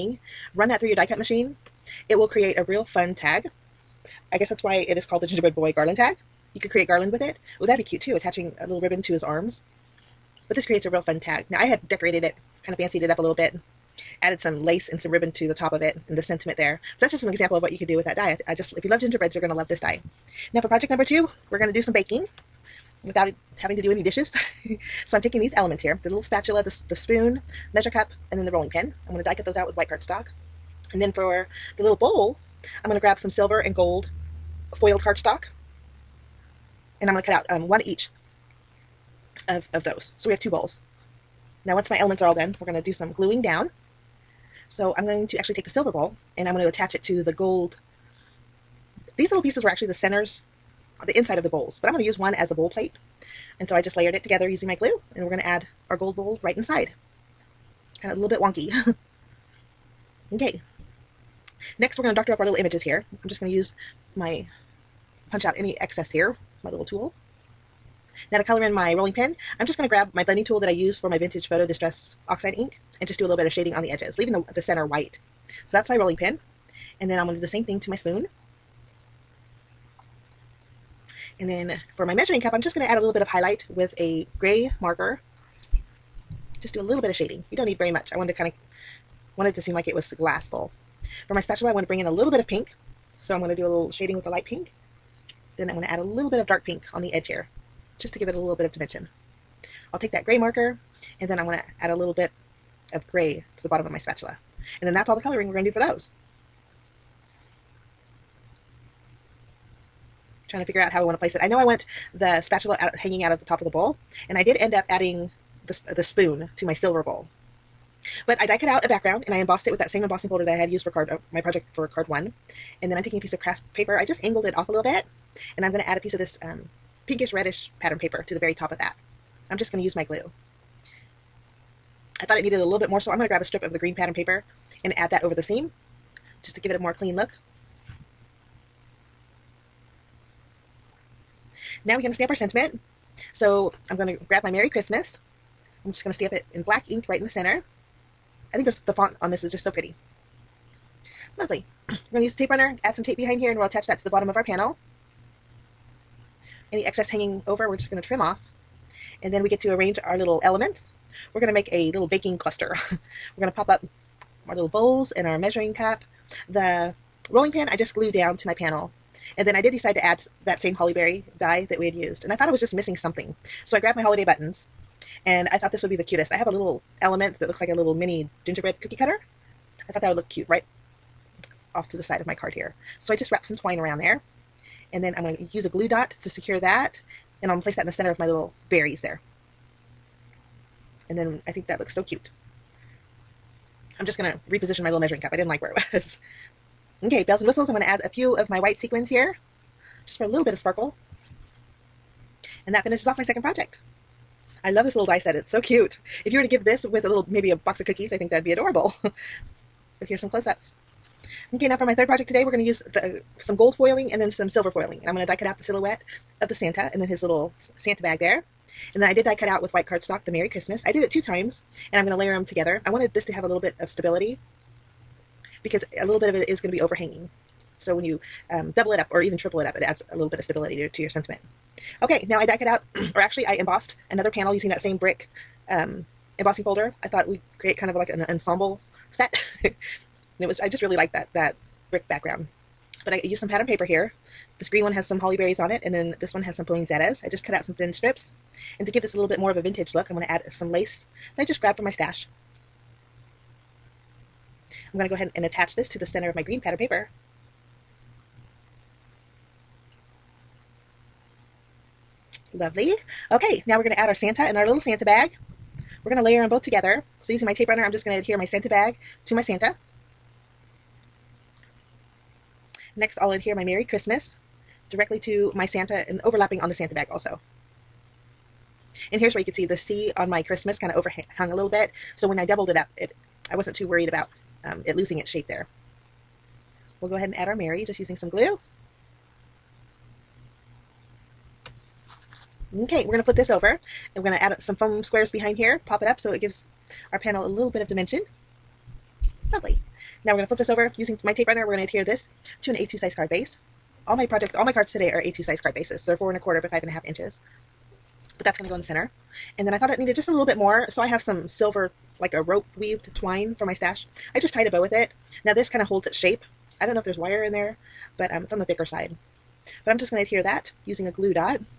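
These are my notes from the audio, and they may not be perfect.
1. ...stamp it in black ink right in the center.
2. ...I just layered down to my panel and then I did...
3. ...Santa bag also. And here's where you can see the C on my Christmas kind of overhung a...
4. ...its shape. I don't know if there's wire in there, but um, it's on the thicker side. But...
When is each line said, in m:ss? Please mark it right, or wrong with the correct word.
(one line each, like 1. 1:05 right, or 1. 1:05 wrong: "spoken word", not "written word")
1. 2:26 right
2. 2:47 wrong: "glued", not "layered"
3. 4:36 right
4. 5:16 right.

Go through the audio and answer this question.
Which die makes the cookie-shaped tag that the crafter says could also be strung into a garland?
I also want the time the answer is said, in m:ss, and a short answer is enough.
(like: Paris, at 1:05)
gingerbread boy garland tag, at 0:05.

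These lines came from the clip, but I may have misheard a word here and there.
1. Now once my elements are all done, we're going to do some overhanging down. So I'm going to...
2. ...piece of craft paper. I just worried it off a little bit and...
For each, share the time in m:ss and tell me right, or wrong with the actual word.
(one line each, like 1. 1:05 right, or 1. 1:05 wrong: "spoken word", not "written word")
1. 0:41 wrong: "gluing", not "overhanging"
2. 2:03 wrong: "angled", not "worried".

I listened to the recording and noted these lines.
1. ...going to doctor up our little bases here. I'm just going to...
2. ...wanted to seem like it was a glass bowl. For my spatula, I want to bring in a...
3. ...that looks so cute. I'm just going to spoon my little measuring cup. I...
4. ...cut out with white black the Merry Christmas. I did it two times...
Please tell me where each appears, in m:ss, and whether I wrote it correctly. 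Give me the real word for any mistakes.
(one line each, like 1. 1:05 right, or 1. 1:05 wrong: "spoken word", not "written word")
1. 1:02 wrong: "images", not "bases"
2. 1:29 right
3. 3:11 wrong: "reposition", not "spoon"
4. 3:39 wrong: "cardstock", not "black".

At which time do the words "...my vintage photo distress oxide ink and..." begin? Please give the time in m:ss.
1:11.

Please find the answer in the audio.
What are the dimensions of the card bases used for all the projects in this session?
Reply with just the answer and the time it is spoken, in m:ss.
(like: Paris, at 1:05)
4 1/4 by 5 1/2 inches, at 5:06.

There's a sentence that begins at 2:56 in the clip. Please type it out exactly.
I have a little element that looks like a little mini gingerbread cookie cutter.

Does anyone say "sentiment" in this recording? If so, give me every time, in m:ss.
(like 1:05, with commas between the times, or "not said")
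0:16, 2:22, 3:51.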